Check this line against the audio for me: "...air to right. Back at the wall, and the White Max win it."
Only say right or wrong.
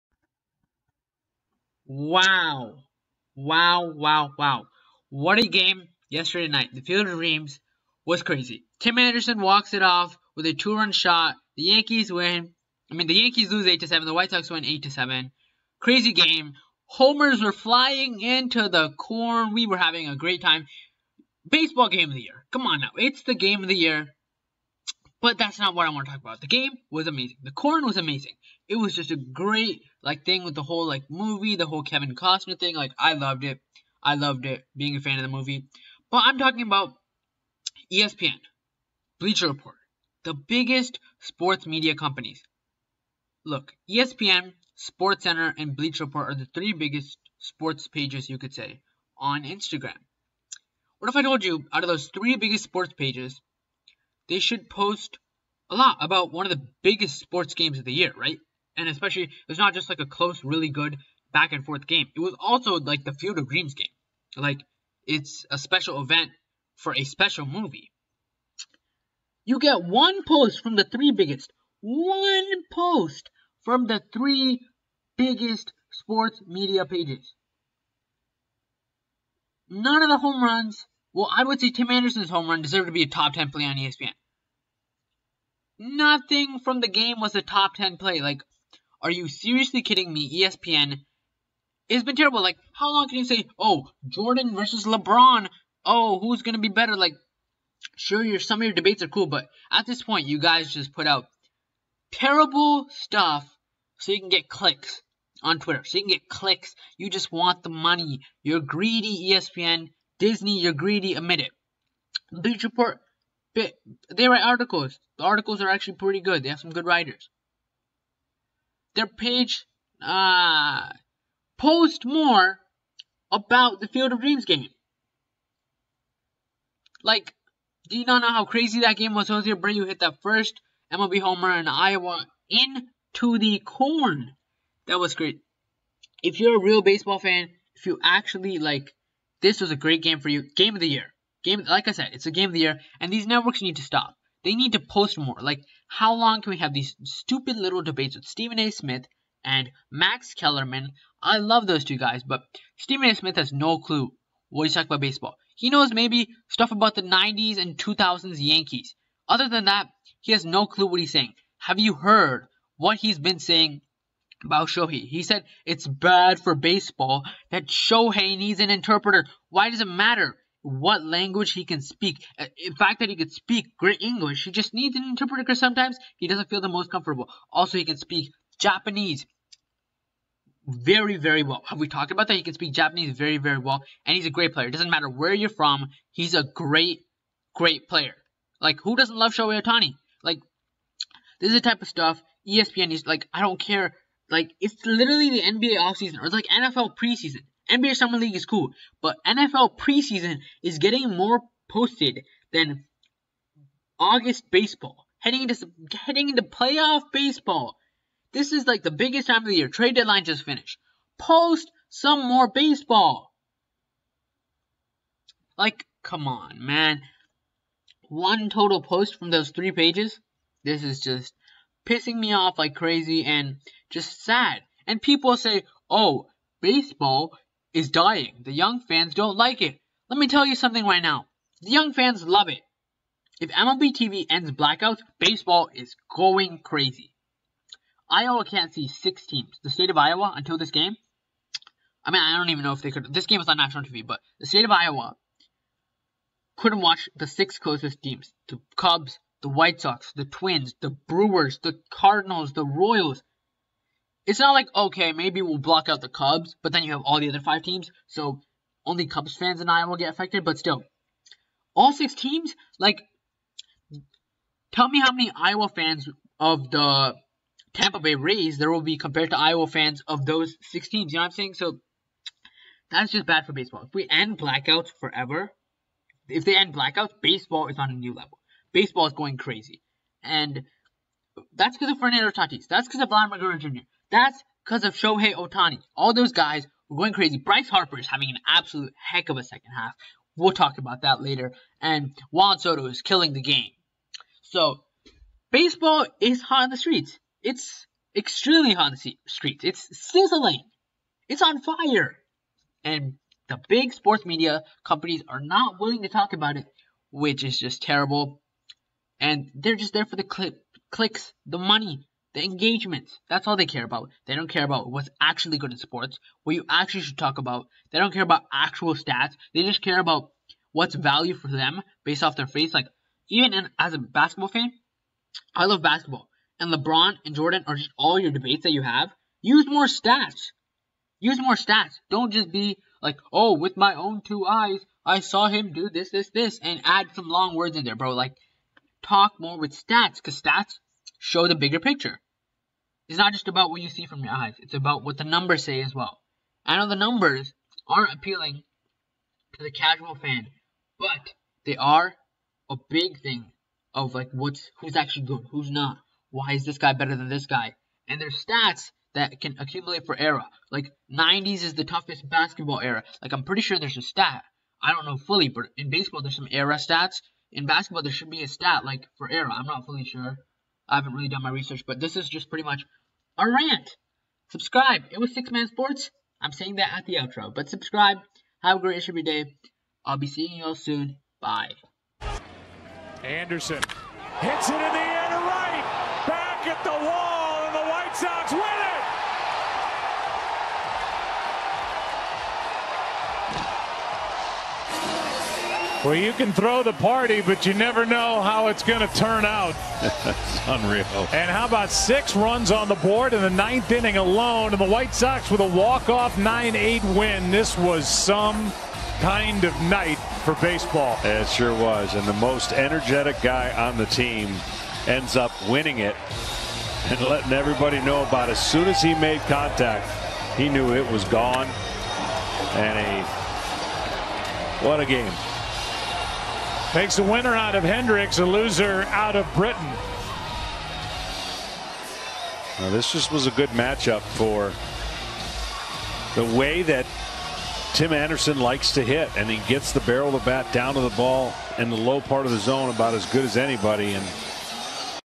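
wrong.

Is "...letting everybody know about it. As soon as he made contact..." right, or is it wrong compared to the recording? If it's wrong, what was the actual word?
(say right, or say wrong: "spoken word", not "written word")
right.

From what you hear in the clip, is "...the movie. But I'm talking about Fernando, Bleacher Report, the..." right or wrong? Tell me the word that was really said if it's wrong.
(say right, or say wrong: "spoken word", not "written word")
wrong: "ESPN", not "Fernando".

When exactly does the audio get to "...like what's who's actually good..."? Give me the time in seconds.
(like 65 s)
354 s.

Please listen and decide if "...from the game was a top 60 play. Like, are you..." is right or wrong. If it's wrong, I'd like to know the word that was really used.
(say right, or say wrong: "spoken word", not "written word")
wrong: "10", not "60".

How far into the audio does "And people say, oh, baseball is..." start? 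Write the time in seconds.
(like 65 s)
224 s.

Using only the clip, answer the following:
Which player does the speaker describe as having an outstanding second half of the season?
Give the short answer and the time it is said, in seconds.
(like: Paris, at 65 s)
Bryce Harper, at 287 s.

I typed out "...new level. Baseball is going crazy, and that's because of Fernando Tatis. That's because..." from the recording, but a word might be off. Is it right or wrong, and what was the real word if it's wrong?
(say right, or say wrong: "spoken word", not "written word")
right.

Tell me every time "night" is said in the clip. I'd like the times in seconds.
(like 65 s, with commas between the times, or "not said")
6 s, 409 s.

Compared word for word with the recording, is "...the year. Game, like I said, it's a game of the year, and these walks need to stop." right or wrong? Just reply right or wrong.
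wrong.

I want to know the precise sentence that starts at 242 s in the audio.
I mean, I don't even know if they could.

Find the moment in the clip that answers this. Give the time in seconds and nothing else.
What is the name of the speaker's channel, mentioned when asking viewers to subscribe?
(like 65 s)
375 s.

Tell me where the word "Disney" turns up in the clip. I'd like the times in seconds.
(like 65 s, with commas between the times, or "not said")
110 s.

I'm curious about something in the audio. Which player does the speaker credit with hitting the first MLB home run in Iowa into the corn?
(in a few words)
Jose Abreu.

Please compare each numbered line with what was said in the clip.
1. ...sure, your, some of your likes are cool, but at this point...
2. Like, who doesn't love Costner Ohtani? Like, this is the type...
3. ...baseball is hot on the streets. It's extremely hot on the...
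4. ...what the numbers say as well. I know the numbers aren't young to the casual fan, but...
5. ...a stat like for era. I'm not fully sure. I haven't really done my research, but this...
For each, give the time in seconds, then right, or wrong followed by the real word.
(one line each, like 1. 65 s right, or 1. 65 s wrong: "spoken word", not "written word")
1. 97 s wrong: "debates", not "likes"
2. 188 s wrong: "Shohei", not "Costner"
3. 295 s right
4. 345 s wrong: "appealing", not "young"
5. 368 s right.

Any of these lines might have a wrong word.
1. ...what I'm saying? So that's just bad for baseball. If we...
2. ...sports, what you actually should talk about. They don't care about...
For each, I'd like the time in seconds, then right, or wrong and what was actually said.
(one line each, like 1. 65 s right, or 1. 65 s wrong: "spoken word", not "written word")
1. 271 s right
2. 315 s right.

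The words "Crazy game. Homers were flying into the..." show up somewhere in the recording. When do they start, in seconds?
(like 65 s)
15 s.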